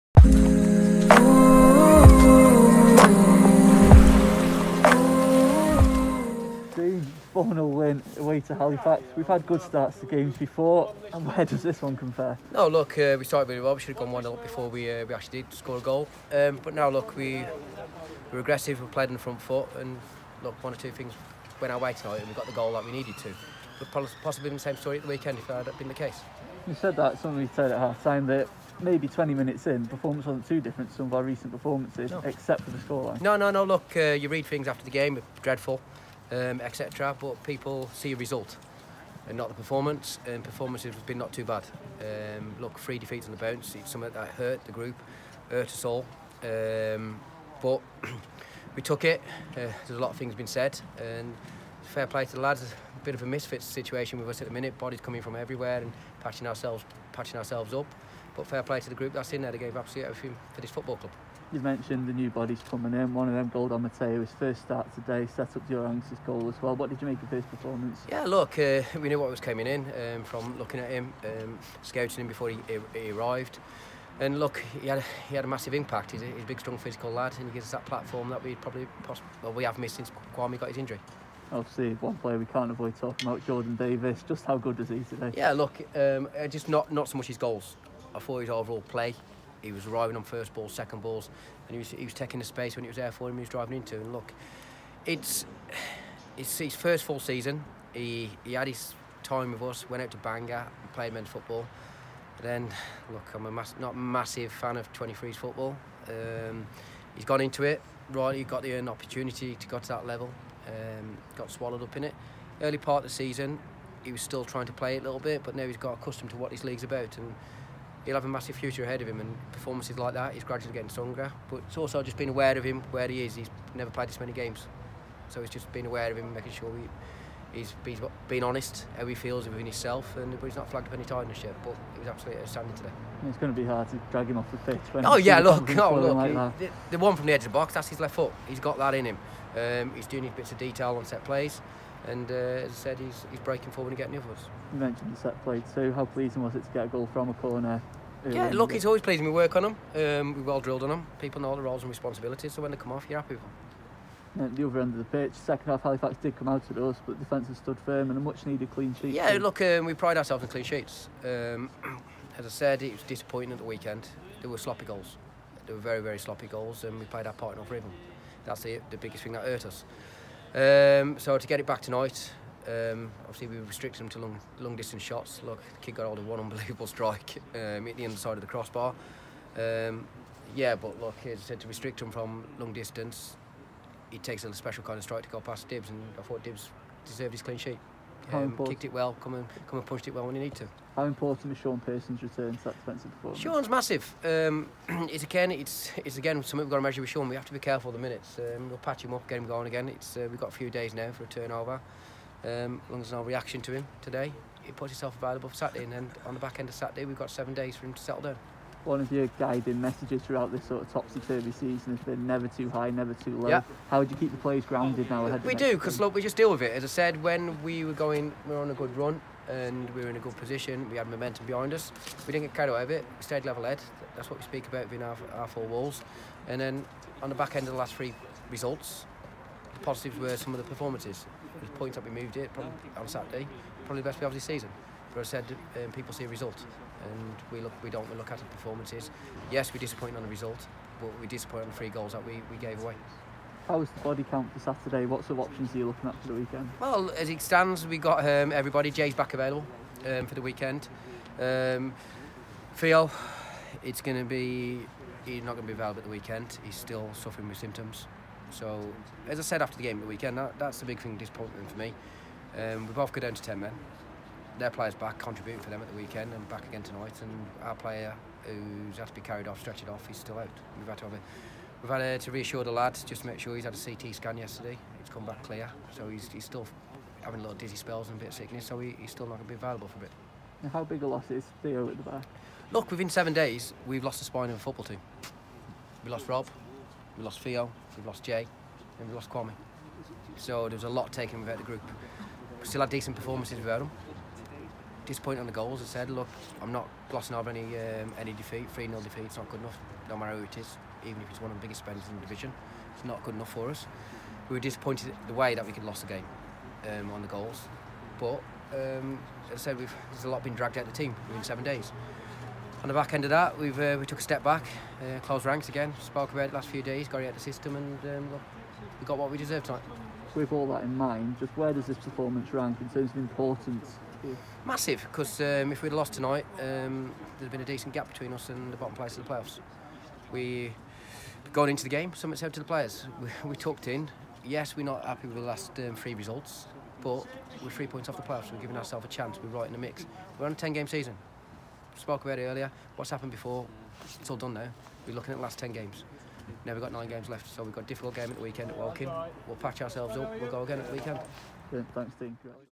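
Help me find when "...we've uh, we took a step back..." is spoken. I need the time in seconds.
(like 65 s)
313 s.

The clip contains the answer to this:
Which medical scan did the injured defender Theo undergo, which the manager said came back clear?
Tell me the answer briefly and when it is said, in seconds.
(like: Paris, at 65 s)
CT scan, at 273 s.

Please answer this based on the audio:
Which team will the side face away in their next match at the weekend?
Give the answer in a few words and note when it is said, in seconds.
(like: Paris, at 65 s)
Woking, at 348 s.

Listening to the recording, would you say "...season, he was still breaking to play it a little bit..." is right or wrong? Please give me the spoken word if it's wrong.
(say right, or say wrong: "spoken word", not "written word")
wrong: "trying", not "breaking".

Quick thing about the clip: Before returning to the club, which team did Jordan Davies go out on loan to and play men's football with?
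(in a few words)
Bangor.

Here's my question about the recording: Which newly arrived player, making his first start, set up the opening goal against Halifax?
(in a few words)
Gold Omotayo.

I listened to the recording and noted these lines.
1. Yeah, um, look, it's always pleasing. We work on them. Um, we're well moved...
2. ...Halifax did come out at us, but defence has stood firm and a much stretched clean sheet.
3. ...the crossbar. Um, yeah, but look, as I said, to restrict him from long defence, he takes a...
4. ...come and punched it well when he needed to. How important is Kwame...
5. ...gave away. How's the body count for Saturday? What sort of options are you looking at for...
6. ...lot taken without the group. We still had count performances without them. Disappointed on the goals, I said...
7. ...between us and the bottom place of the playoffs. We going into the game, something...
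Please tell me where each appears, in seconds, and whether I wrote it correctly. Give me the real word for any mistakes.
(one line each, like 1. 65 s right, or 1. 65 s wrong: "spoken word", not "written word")
1. 148 s wrong: "drilled", not "moved"
2. 155 s wrong: "needed", not "stretched"
3. 178 s wrong: "distance", not "defence"
4. 189 s wrong: "Sean", not "Kwame"
5. 242 s right
6. 290 s wrong: "decent", not "count"
7. 328 s right.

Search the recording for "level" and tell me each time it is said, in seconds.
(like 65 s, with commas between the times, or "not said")
110 s, 223 s.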